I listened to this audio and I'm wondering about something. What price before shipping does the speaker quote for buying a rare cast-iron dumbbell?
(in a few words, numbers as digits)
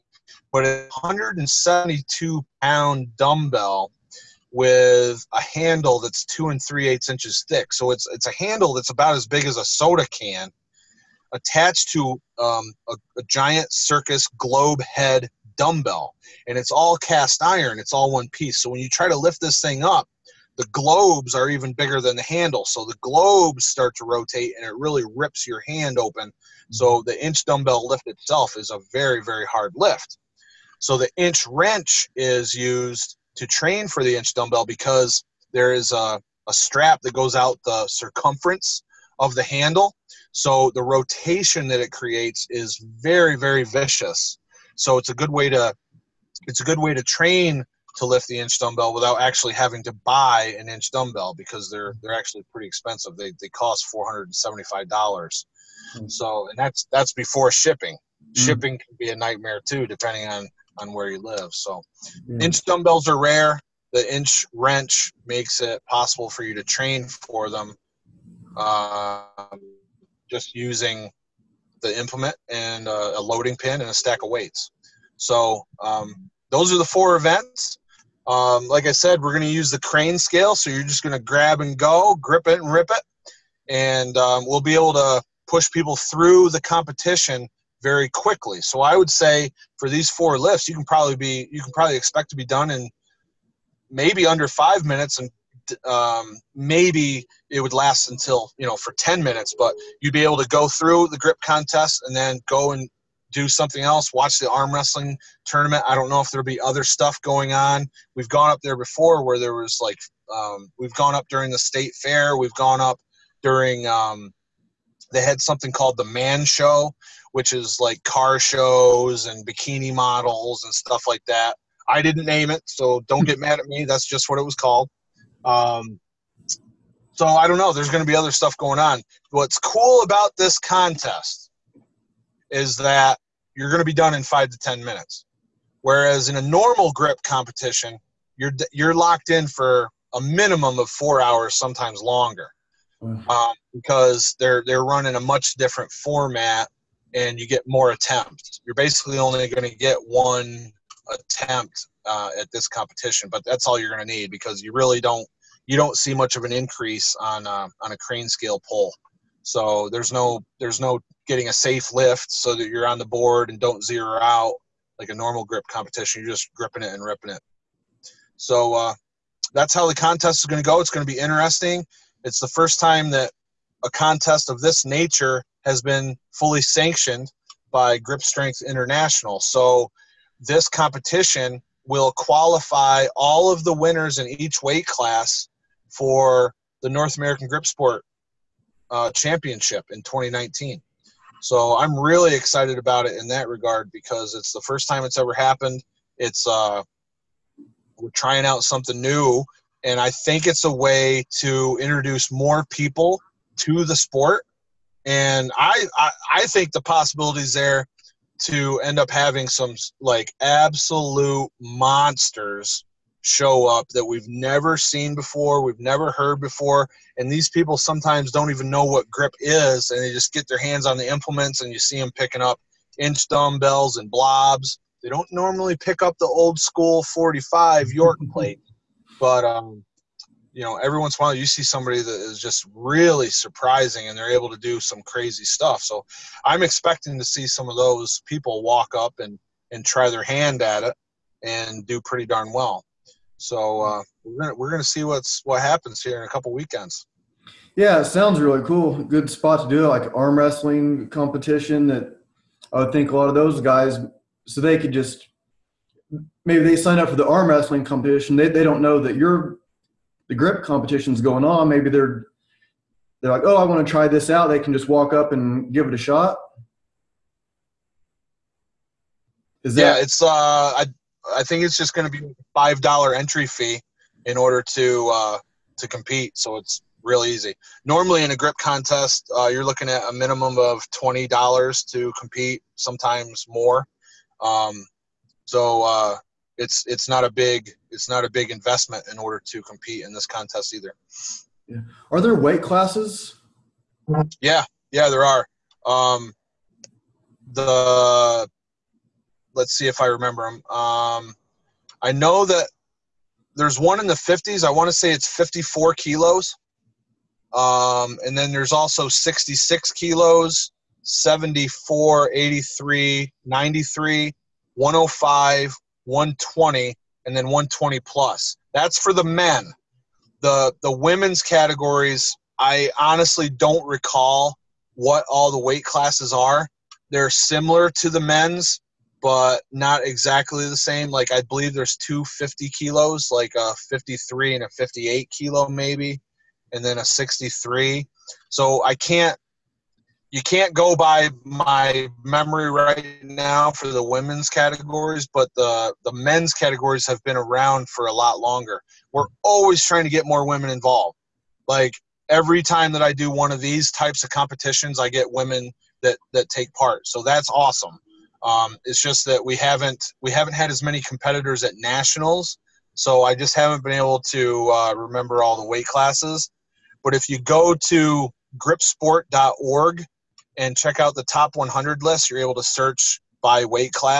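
$475.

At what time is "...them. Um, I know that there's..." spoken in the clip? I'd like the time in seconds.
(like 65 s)
300 s.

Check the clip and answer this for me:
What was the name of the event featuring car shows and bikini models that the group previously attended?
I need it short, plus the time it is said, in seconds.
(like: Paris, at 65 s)
the Man Show, at 115 s.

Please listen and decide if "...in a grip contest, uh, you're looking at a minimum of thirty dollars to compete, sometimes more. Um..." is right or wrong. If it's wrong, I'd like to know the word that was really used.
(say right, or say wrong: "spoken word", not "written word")
wrong: "twenty", not "thirty".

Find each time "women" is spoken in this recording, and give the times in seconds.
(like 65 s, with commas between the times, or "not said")
320 s, 344 s, 350 s, 355 s.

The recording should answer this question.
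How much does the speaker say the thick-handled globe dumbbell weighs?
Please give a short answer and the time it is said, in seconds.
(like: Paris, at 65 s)
172 pounds, at 1 s.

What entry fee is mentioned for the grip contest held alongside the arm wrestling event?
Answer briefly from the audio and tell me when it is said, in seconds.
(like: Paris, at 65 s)
$5, at 272 s.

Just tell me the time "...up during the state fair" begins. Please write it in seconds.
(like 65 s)
111 s.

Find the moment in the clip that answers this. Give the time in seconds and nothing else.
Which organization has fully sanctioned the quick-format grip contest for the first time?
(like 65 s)
177 s.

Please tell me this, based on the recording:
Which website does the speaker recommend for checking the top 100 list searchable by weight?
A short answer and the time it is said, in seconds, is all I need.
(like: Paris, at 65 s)
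gripsport.org, at 368 s.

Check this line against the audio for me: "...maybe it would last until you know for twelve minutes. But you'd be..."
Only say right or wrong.
wrong.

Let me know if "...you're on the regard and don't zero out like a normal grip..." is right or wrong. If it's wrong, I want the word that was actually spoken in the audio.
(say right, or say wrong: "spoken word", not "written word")
wrong: "board", not "regard".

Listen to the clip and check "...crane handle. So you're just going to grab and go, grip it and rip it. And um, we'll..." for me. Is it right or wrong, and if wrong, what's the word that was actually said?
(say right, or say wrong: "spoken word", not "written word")
wrong: "scale", not "handle".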